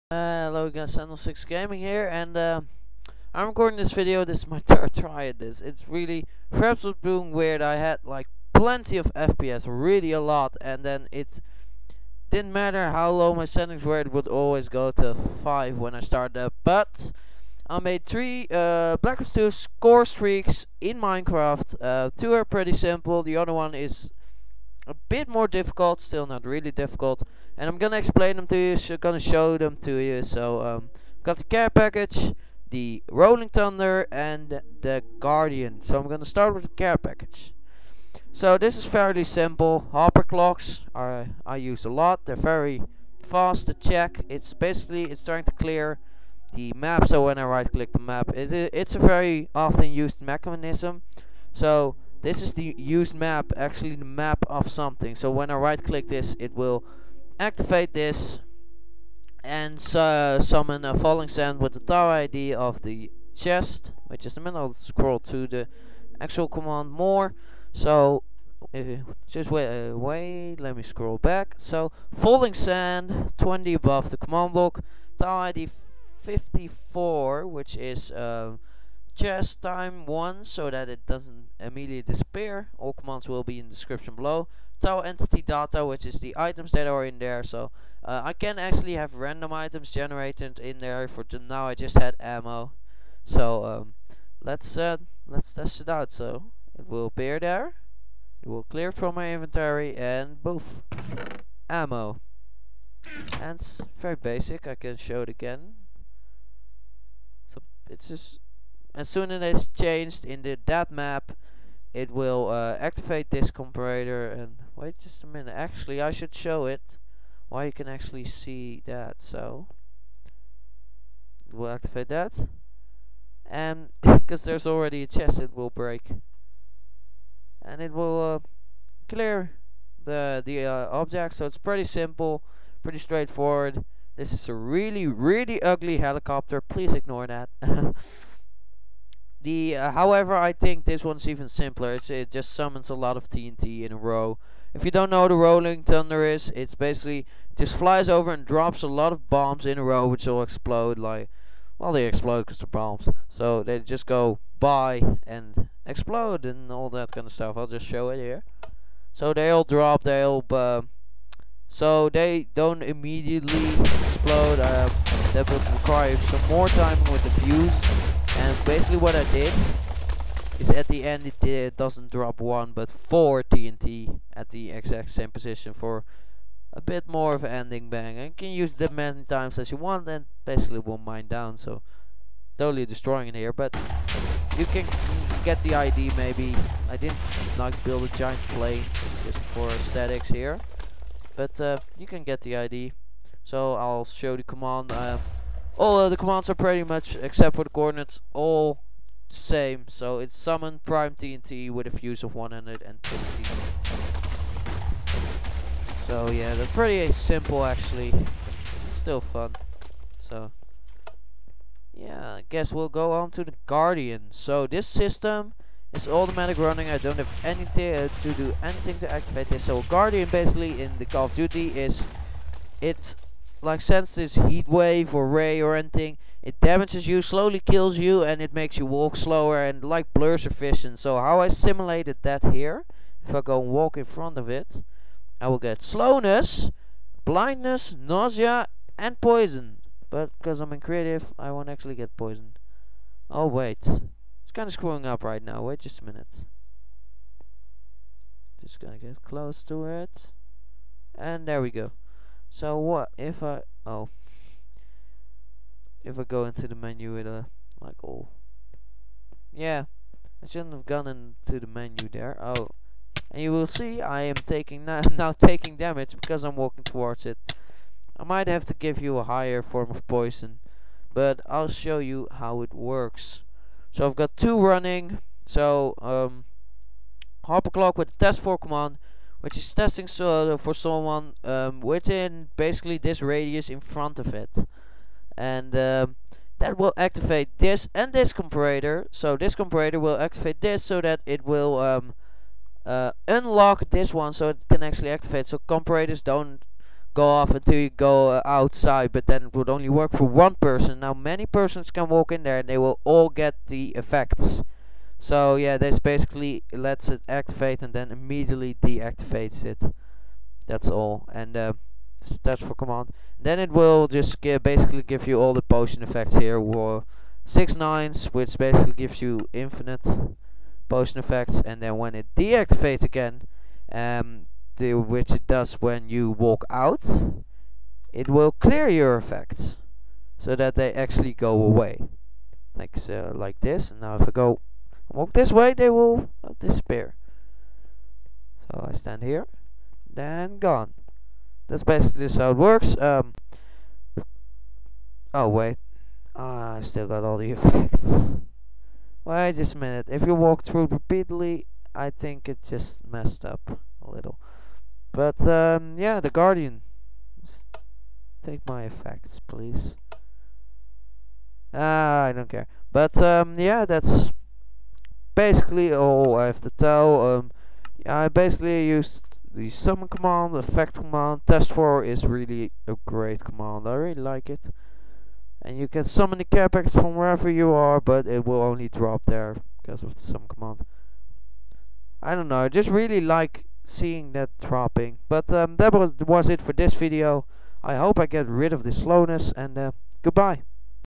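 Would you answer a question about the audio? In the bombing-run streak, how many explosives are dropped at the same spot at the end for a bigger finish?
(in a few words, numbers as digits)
4.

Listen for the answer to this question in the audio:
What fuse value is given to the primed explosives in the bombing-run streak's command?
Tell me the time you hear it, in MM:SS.
03:21.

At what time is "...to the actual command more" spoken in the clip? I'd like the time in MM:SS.
01:05.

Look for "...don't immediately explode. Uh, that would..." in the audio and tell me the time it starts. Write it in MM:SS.
02:42.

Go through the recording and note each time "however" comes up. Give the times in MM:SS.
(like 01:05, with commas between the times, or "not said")
02:19.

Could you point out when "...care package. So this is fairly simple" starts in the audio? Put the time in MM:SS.
00:36.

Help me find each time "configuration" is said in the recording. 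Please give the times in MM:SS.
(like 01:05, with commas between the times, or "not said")
not said.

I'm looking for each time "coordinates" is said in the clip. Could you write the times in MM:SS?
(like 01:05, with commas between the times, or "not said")
03:17.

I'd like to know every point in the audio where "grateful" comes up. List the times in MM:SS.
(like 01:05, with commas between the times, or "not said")
not said.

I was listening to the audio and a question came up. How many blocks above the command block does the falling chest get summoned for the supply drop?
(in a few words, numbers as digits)
20.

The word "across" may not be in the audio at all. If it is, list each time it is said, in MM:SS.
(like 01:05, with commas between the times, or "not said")
not said.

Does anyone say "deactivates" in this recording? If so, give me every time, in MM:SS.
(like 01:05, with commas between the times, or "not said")
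05:08, 05:22.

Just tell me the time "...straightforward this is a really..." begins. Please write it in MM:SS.
02:12.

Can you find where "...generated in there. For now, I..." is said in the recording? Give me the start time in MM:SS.
01:29.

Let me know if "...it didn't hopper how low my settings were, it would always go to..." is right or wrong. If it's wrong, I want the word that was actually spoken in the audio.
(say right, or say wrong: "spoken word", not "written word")
wrong: "matter", not "hopper".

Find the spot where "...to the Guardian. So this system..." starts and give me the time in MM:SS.
03:33.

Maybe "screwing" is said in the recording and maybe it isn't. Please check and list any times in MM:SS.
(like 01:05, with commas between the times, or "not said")
04:04.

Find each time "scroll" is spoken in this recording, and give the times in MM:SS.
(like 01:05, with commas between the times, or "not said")
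01:04, 01:10.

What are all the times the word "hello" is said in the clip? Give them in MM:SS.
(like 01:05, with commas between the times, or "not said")
00:00.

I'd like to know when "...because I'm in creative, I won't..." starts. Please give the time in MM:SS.
04:00.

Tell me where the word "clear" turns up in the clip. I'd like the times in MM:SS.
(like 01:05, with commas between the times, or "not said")
00:45, 01:38, 02:09, 05:28.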